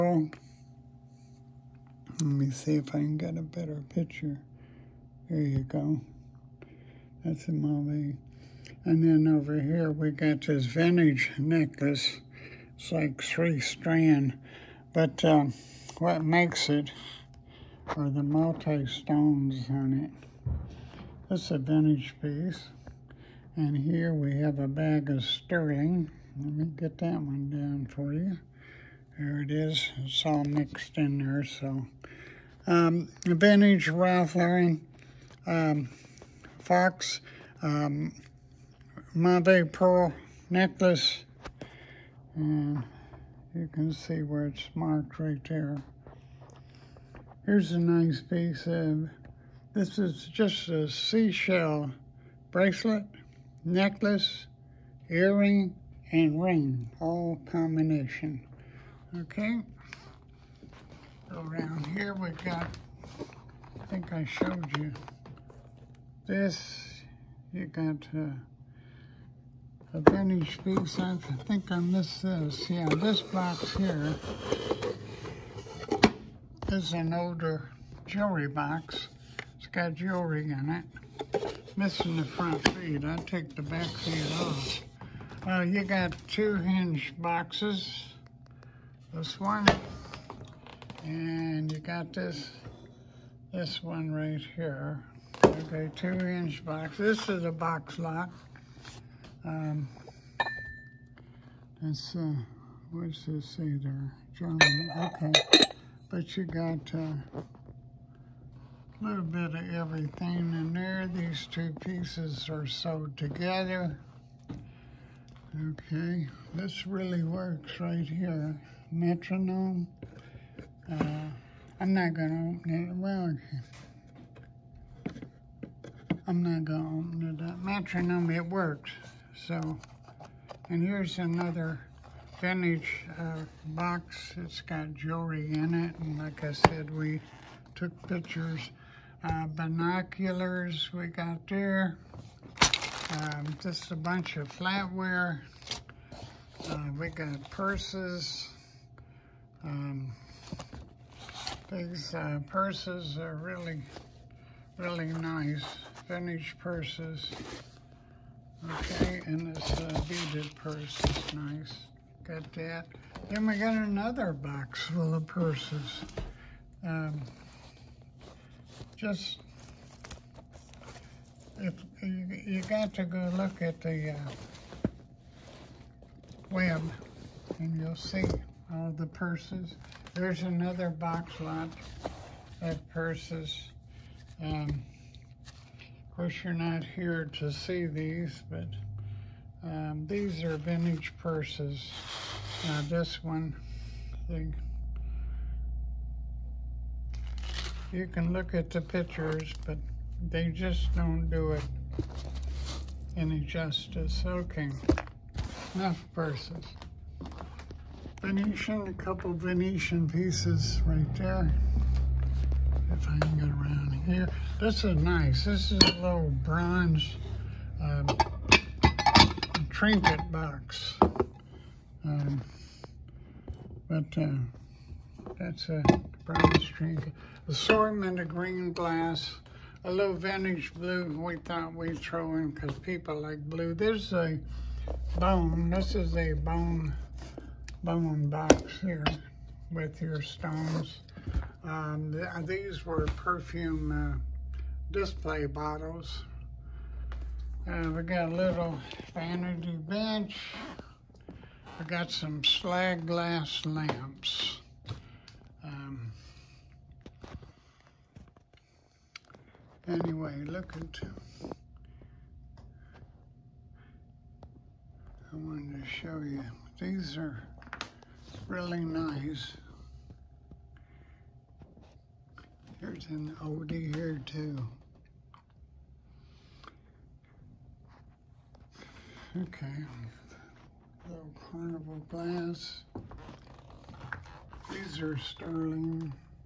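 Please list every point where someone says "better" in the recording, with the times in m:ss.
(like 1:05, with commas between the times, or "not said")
0:03.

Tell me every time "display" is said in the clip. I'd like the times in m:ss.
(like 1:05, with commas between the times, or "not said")
4:04.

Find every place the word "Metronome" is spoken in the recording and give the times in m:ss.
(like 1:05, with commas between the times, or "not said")
1:58, 2:07.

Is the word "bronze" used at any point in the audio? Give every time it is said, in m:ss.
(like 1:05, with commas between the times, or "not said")
3:36, 3:46.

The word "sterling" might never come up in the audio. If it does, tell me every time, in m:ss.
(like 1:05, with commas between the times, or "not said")
0:25, 4:45.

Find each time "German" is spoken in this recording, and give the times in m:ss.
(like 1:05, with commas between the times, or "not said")
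1:44.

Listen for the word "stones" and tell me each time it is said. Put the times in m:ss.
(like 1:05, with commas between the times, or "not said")
0:18, 4:00.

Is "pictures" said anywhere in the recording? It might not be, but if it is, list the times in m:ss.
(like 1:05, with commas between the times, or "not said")
0:03, 2:18, 3:18.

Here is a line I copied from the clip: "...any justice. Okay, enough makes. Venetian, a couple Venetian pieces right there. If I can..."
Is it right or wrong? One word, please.
wrong.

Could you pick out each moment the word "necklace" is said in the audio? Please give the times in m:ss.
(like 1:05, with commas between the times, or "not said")
0:11, 0:40, 0:53.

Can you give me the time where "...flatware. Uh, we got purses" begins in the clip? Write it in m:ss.
2:24.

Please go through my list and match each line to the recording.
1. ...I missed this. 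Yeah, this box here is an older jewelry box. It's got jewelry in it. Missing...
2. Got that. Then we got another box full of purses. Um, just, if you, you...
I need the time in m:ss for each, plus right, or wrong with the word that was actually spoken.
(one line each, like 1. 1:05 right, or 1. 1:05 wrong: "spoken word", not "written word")
1. 1:11 right
2. 2:42 right.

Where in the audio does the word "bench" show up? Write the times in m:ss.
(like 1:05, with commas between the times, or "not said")
4:09.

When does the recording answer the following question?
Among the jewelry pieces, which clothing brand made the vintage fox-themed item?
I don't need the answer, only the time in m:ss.
0:33.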